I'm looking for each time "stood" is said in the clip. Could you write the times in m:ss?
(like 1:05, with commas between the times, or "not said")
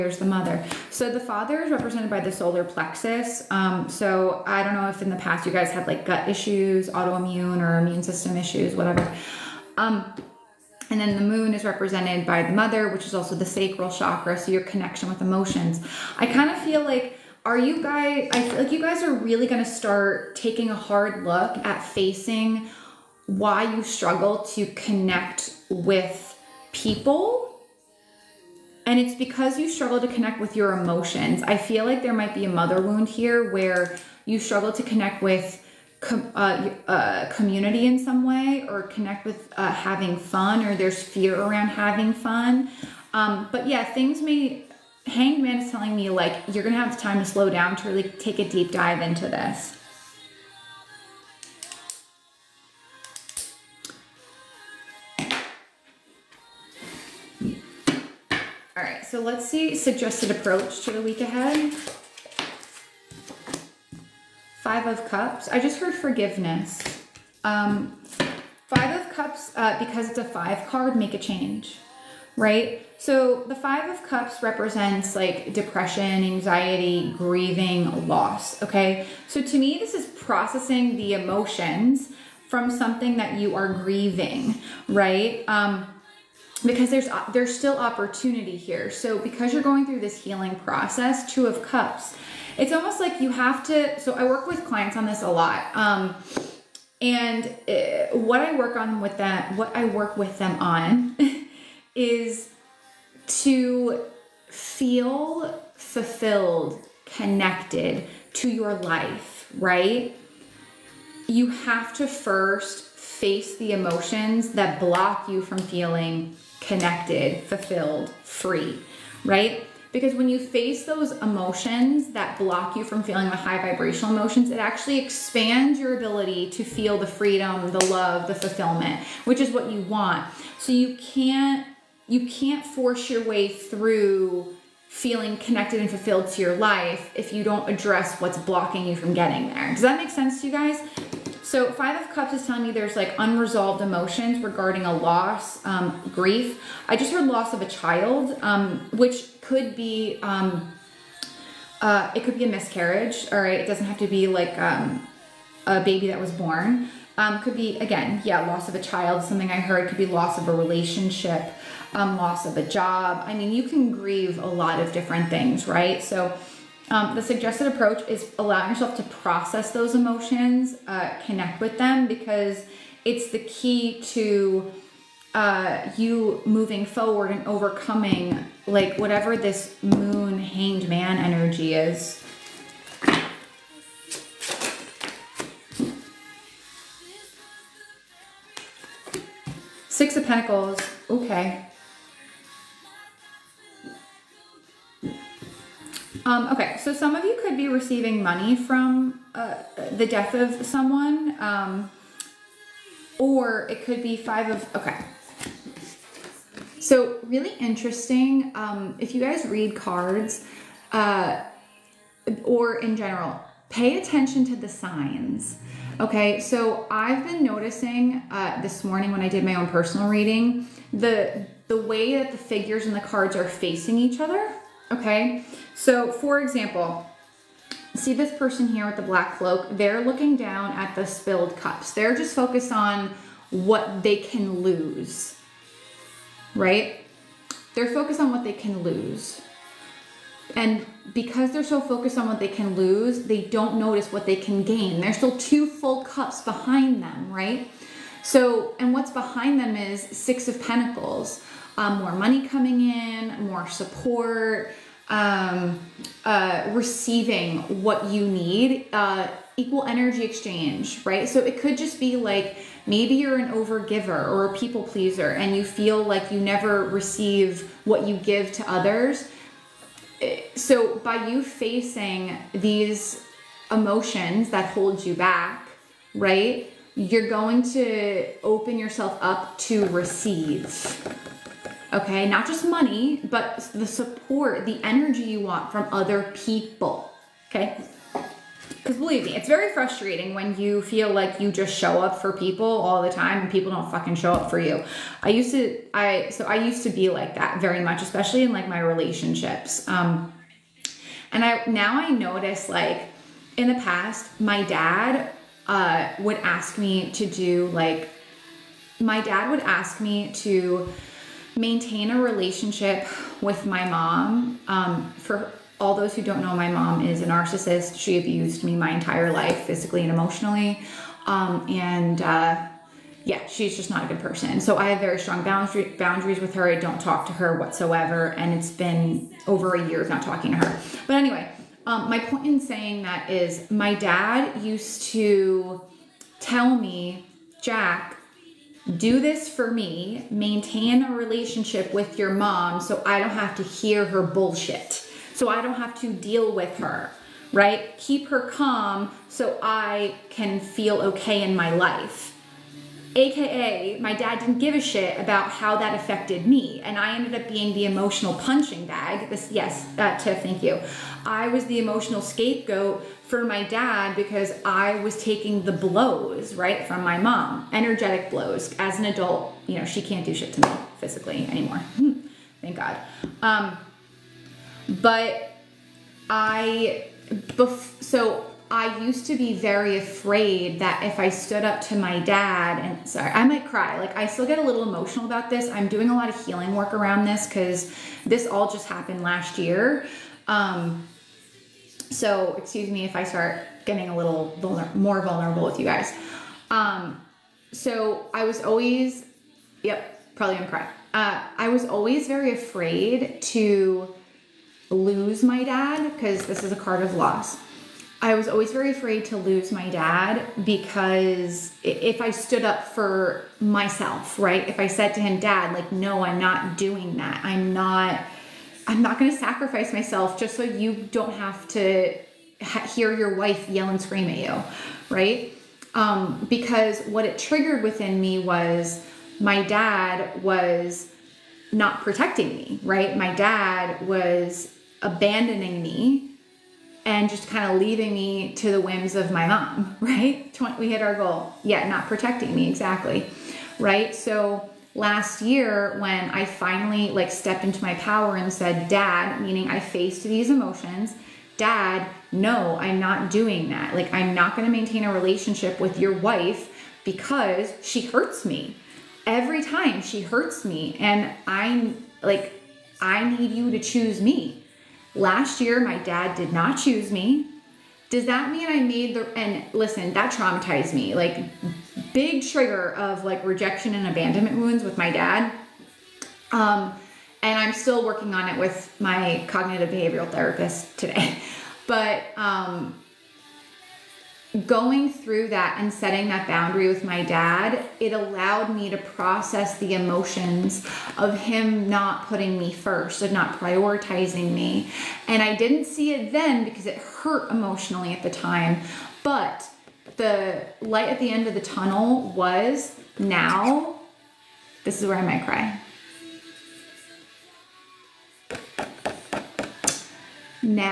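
6:21, 6:52.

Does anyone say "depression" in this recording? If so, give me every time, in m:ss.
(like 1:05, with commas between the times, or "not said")
1:15.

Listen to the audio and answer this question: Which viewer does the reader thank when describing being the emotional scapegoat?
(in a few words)
Tiff.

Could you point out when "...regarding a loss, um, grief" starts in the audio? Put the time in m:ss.
2:24.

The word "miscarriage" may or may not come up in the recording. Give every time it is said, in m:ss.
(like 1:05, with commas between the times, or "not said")
2:32.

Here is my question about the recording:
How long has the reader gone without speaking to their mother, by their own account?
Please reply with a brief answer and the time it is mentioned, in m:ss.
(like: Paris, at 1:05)
Over a year, at 5:29.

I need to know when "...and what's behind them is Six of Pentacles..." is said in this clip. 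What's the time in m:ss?
4:08.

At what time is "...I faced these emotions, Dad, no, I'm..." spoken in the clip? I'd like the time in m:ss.
7:29.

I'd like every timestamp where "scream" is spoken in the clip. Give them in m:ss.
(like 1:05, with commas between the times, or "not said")
7:04.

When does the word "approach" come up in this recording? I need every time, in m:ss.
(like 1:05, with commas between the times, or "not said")
1:00, 2:47.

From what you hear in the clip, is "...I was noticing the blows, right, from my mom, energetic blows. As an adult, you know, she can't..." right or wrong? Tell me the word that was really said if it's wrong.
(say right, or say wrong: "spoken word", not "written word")
wrong: "taking", not "noticing".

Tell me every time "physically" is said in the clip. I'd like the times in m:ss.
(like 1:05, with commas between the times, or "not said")
5:19, 6:10.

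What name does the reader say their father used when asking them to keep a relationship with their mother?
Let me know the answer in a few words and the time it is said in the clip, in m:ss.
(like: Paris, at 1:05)
Jack, at 5:37.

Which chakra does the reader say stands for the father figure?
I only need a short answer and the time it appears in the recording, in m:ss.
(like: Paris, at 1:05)
Solar plexus, at 0:02.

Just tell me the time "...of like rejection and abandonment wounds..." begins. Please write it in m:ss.
7:52.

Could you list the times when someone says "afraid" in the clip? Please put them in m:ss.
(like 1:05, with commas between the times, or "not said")
6:19, 6:42, 6:48.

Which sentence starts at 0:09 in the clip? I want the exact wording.
Um, and then the moon is represented by the mother, which is also the sacral chakra, so your connection with emotions.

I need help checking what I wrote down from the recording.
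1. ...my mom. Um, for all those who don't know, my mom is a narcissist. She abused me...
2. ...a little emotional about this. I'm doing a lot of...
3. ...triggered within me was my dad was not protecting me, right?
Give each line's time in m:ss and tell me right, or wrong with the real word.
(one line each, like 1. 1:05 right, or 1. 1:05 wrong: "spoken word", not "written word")
1. 5:13 right
2. 6:24 right
3. 7:07 right.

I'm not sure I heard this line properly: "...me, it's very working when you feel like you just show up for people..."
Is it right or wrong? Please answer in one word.
wrong.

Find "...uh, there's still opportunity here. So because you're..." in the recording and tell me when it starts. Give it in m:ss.
1:27.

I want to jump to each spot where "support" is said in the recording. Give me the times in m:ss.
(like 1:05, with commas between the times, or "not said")
4:13, 4:43.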